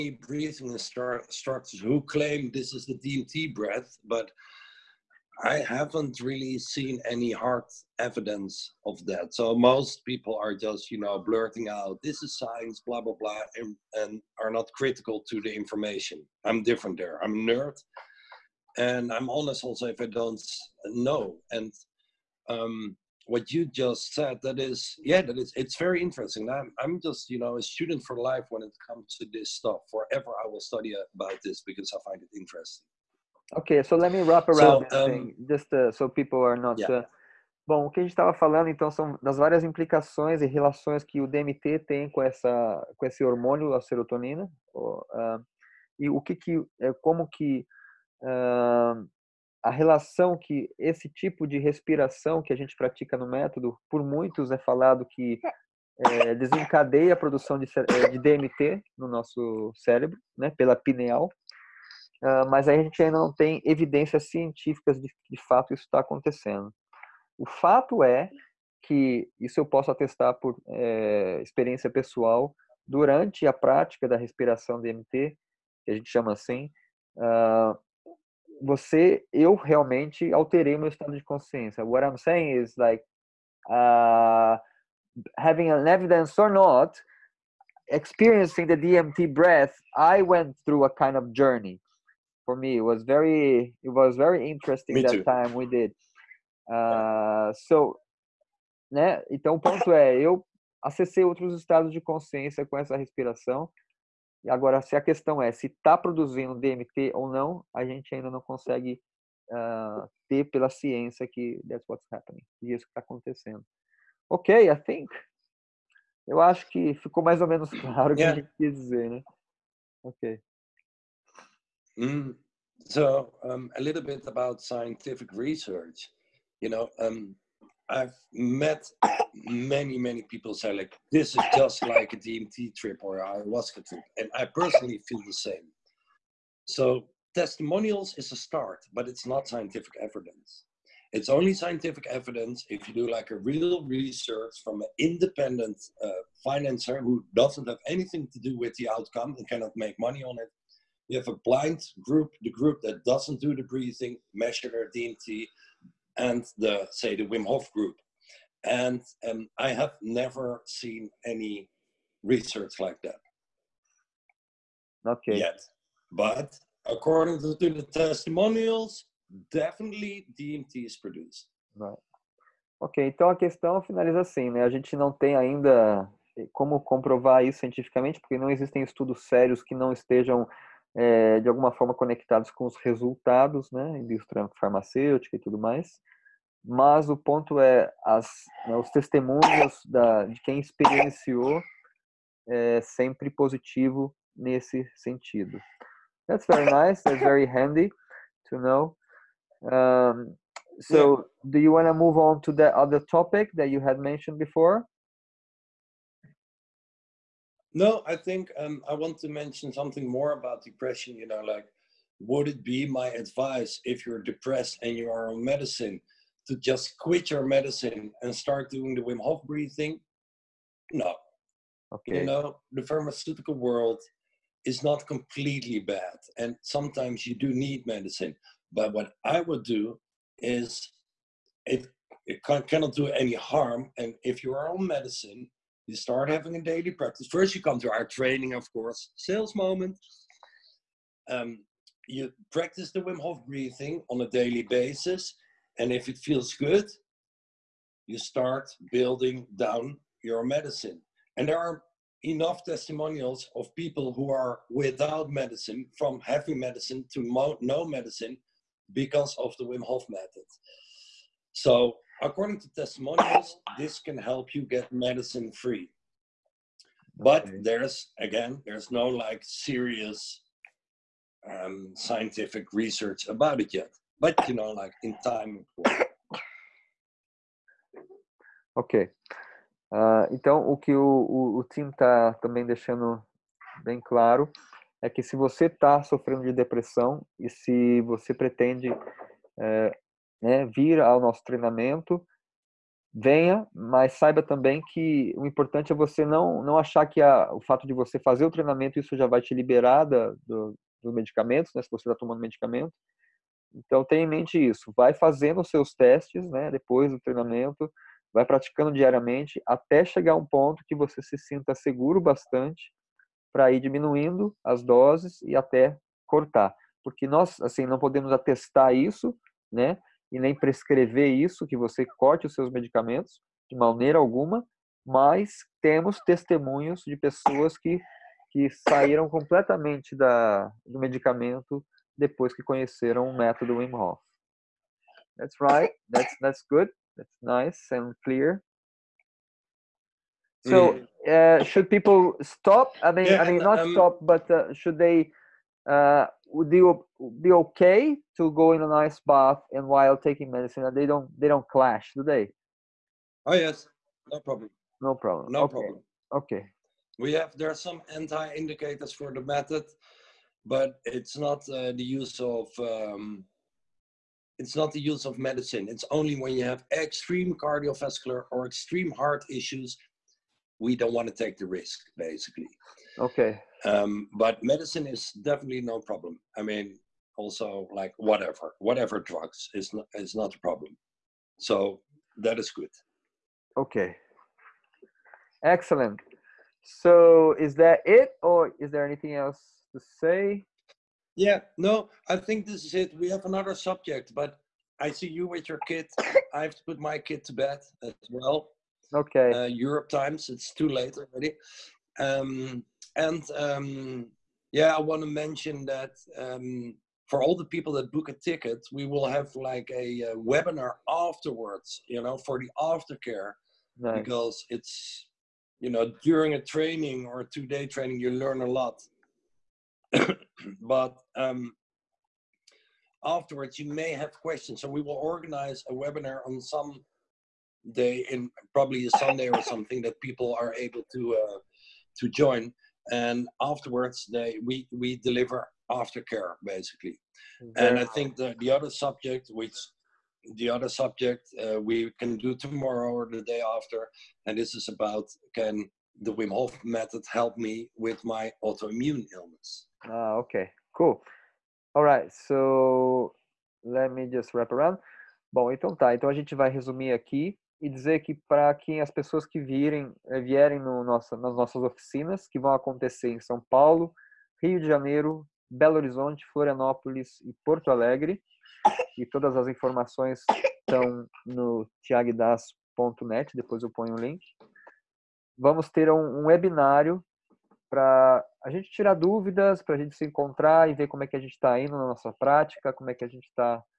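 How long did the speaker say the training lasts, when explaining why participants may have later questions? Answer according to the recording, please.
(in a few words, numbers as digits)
two day.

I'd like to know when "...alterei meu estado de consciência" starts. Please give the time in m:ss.
1:20.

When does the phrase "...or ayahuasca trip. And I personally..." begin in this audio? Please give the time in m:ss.
2:13.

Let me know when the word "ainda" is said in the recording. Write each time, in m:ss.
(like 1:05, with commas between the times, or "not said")
1:03, 1:48, 2:55.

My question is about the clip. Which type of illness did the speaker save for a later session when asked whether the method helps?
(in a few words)
autoimmune illness.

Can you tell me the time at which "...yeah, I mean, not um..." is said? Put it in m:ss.
5:43.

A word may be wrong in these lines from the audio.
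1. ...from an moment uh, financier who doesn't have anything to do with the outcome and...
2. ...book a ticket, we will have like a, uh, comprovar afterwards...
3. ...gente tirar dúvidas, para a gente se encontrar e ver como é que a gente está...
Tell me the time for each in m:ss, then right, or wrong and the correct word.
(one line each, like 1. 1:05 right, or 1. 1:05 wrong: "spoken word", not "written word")
1. 2:24 wrong: "independent", not "moment"
2. 6:48 wrong: "webinar", not "comprovar"
3. 7:58 right.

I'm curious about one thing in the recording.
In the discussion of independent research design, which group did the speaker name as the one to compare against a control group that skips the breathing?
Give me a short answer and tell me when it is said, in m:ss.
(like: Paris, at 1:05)
the Wim Hof group, at 2:37.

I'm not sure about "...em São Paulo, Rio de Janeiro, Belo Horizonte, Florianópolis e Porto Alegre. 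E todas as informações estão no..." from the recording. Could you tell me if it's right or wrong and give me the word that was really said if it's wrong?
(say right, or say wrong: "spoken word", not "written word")
right.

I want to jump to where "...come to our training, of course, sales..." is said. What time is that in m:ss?
3:57.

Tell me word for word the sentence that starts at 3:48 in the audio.
But what I would do is it, it can, cannot do any harm.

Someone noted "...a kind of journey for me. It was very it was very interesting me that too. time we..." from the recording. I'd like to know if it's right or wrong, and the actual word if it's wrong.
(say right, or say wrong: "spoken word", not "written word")
right.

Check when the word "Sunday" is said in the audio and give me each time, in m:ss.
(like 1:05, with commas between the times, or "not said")
7:09.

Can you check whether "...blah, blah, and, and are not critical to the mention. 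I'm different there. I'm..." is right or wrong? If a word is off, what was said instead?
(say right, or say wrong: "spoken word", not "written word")
wrong: "information", not "mention".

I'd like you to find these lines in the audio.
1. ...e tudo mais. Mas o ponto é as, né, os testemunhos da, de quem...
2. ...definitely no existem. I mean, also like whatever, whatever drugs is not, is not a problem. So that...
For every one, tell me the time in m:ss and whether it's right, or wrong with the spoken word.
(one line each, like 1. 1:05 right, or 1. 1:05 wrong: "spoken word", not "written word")
1. 3:05 right
2. 6:15 wrong: "problem", not "existem".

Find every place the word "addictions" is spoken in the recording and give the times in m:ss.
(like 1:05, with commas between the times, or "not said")
not said.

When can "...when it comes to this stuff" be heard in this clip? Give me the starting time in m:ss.
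0:28.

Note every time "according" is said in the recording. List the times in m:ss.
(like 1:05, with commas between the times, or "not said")
2:46, 4:22.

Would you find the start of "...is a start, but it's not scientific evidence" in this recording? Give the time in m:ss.
2:18.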